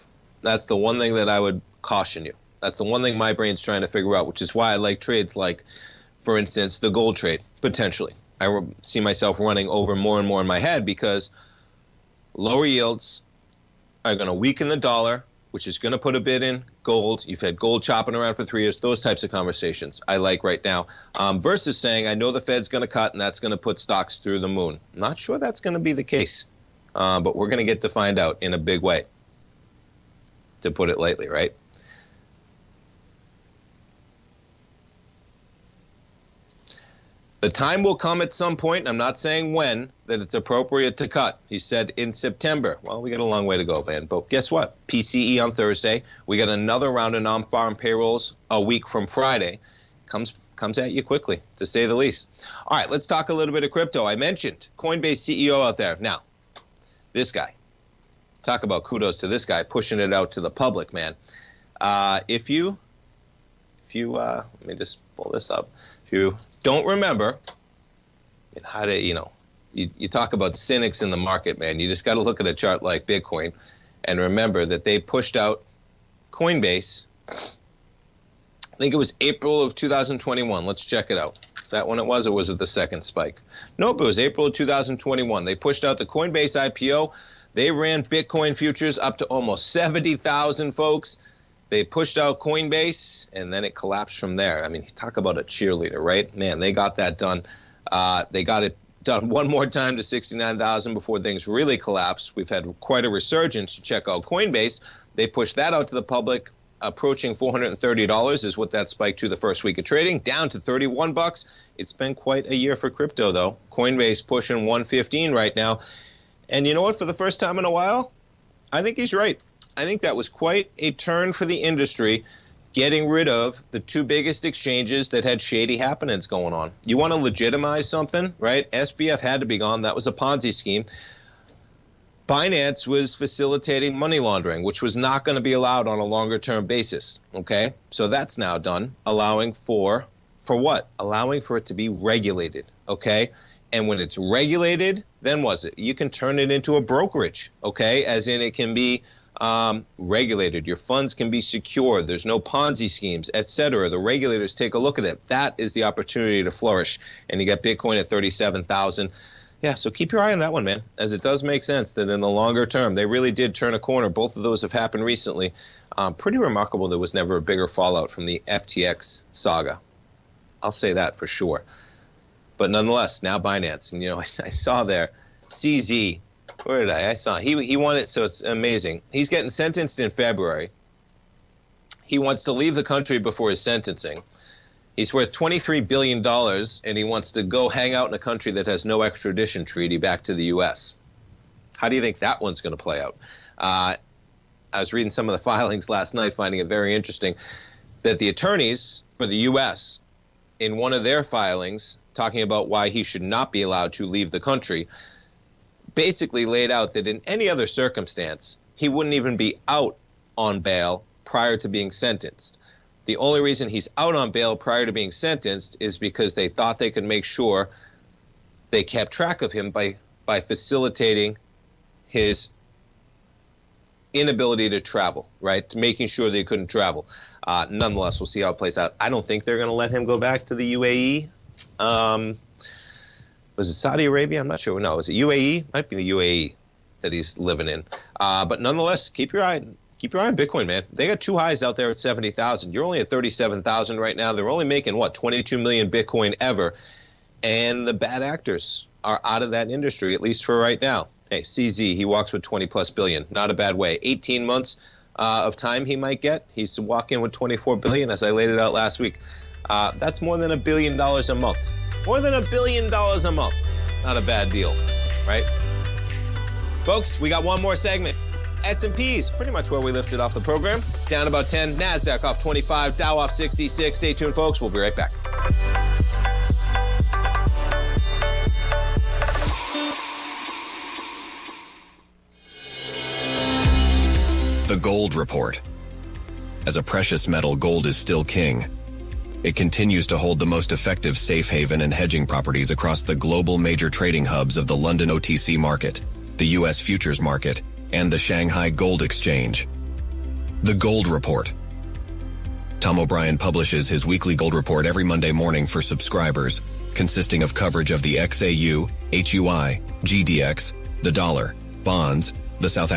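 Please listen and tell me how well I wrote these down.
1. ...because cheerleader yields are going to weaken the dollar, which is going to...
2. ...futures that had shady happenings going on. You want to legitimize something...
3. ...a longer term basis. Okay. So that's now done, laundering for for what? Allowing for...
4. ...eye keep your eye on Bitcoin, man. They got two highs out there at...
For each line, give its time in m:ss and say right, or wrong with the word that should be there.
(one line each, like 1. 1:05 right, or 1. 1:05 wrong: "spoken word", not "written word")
1. 0:10 wrong: "lower", not "cheerleader"
2. 2:04 wrong: "exchanges", not "futures"
3. 2:15 wrong: "allowing", not "laundering"
4. 3:59 right.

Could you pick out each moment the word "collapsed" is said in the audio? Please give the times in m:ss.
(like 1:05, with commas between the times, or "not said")
1:33, 1:41.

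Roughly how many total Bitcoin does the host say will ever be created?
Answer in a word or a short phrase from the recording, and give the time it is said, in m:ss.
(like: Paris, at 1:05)
22 million, at 4:05.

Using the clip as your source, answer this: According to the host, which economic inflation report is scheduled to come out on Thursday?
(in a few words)
PCE.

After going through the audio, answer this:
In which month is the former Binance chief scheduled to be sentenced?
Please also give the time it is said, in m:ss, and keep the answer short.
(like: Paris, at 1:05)
February, at 3:00.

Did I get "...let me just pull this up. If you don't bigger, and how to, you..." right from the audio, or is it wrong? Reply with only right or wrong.
wrong.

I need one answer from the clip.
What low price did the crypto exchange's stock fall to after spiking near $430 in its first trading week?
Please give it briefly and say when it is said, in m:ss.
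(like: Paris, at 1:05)
31 bucks, at 1:50.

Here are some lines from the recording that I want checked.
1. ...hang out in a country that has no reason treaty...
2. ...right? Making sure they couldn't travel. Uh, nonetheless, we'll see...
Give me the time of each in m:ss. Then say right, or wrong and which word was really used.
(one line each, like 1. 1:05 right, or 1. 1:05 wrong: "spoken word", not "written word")
1. 3:07 wrong: "extradition", not "reason"
2. 3:45 right.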